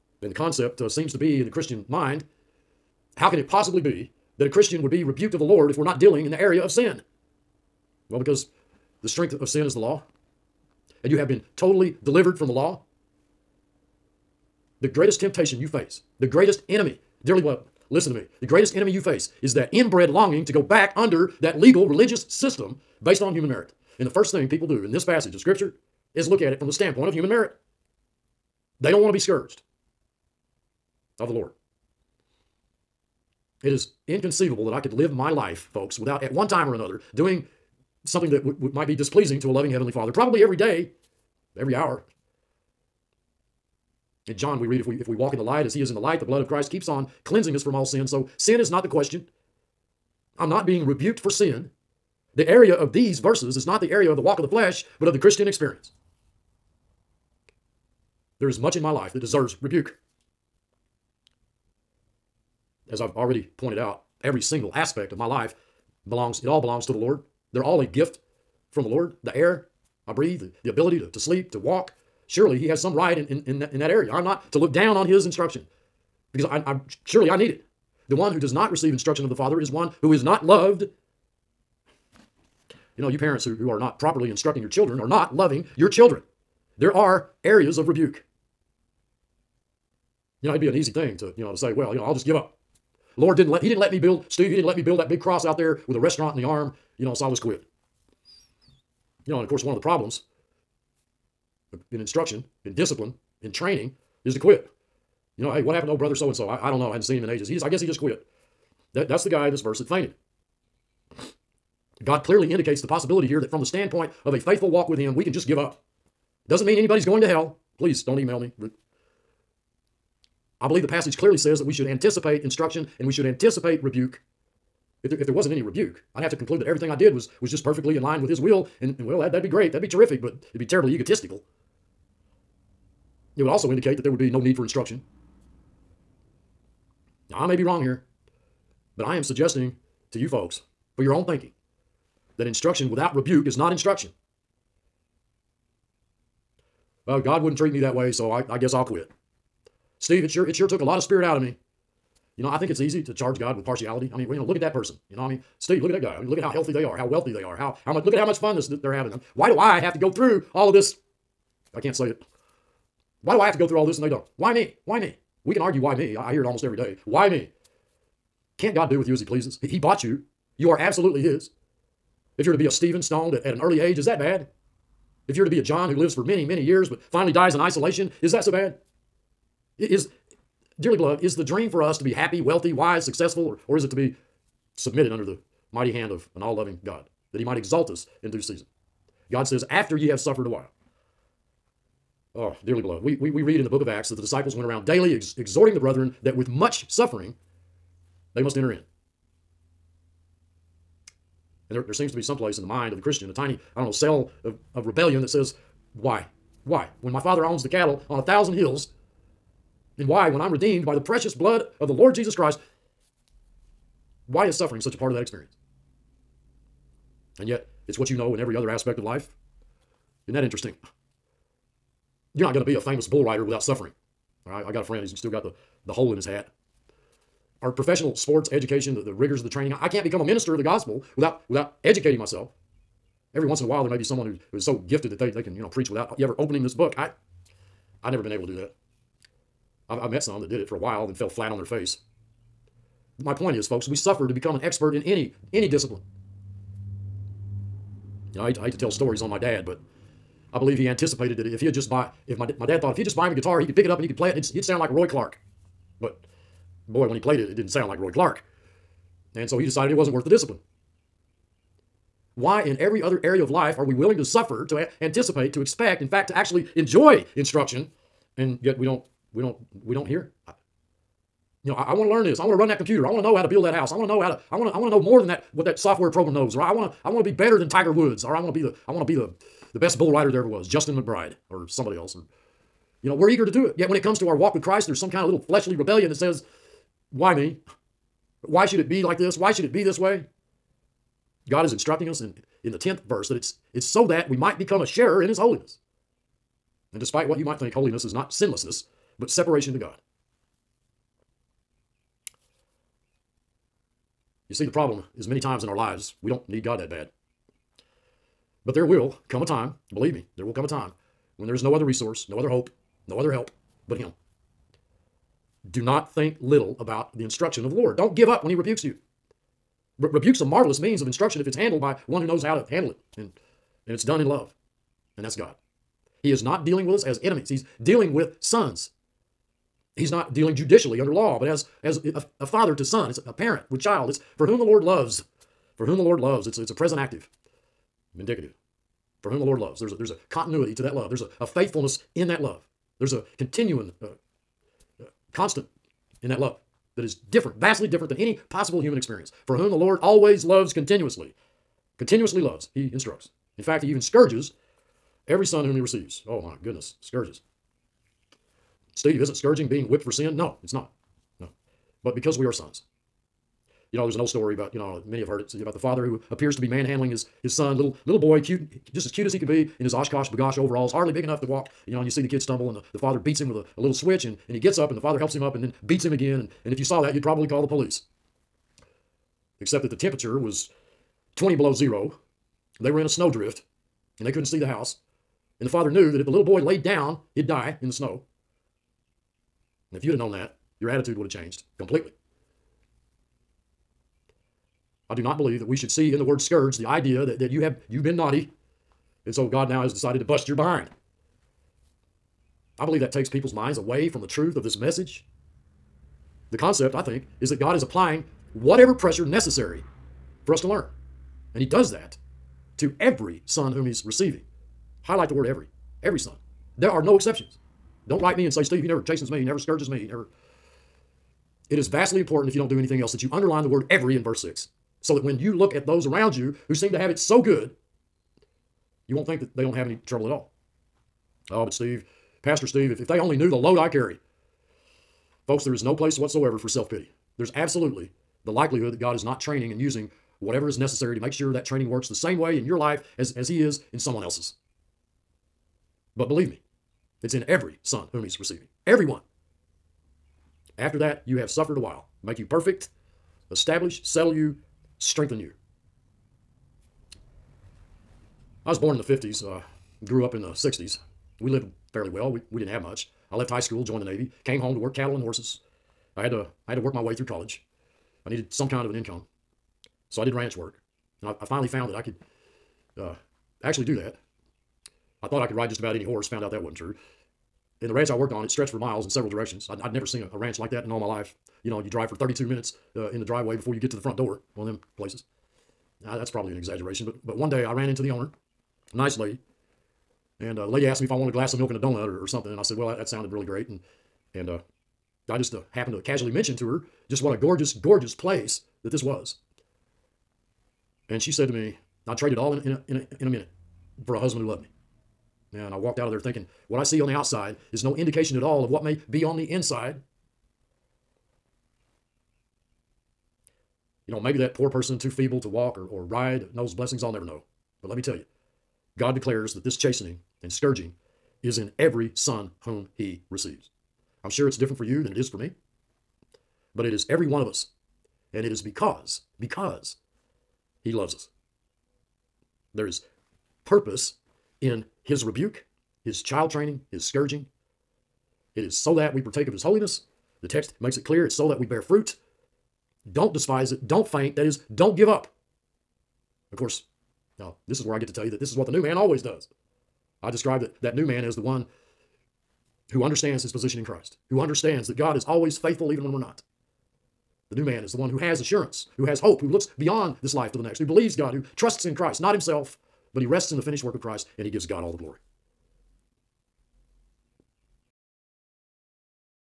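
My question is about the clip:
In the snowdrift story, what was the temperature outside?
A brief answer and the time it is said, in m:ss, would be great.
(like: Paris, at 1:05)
20 below zero, at 6:21.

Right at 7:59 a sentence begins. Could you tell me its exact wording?
I'd, I'd never seen a, a, ranch like that in all my life.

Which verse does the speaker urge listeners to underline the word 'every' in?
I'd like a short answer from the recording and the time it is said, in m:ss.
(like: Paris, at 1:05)
verse 6, at 7:04.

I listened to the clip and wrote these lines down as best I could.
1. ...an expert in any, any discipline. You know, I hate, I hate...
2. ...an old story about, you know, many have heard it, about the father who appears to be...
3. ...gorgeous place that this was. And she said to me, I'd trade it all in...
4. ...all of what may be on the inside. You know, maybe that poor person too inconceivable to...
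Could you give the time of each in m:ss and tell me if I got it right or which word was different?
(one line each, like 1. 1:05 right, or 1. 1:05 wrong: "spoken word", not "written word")
1. 4:04 right
2. 6:04 right
3. 8:17 right
4. 8:28 wrong: "feeble", not "inconceivable".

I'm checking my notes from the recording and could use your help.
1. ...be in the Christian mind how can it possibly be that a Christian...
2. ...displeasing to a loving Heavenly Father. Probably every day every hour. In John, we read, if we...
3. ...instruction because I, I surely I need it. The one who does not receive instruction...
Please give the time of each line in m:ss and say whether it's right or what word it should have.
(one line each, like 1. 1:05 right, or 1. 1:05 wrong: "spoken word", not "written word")
1. 0:01 right
2. 0:38 right
3. 1:15 right.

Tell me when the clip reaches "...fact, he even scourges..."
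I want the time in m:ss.
5:53.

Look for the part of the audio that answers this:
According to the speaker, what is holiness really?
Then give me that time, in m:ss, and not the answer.
4:59.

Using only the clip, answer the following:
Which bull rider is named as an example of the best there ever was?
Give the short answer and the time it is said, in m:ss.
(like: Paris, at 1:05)
Justin McBride, at 4:40.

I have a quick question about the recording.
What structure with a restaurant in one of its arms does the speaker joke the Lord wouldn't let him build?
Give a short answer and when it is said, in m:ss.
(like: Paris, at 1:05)
big cross, at 1:35.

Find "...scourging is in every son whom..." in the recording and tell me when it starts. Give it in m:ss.
8:40.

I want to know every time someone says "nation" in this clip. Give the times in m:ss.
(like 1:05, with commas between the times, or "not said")
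not said.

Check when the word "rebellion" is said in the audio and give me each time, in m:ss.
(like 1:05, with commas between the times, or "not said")
3:24, 4:45.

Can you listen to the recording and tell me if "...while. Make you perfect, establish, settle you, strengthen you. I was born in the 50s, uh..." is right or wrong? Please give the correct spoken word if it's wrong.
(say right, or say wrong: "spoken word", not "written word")
right.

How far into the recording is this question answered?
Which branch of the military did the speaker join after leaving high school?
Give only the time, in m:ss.
7:44.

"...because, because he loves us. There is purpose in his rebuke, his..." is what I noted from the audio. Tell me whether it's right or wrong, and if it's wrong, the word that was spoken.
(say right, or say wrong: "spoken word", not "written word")
right.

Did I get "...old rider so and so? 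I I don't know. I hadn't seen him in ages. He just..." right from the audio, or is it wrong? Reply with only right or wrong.
wrong.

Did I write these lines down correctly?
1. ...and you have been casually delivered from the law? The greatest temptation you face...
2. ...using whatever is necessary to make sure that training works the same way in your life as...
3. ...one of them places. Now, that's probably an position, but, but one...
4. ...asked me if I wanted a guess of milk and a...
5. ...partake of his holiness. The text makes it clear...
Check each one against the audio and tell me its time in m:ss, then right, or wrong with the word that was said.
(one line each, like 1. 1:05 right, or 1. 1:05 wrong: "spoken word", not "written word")
1. 0:11 wrong: "totally", not "casually"
2. 7:19 right
3. 8:04 wrong: "exaggeration", not "position"
4. 8:10 wrong: "glass", not "guess"
5. 8:59 right.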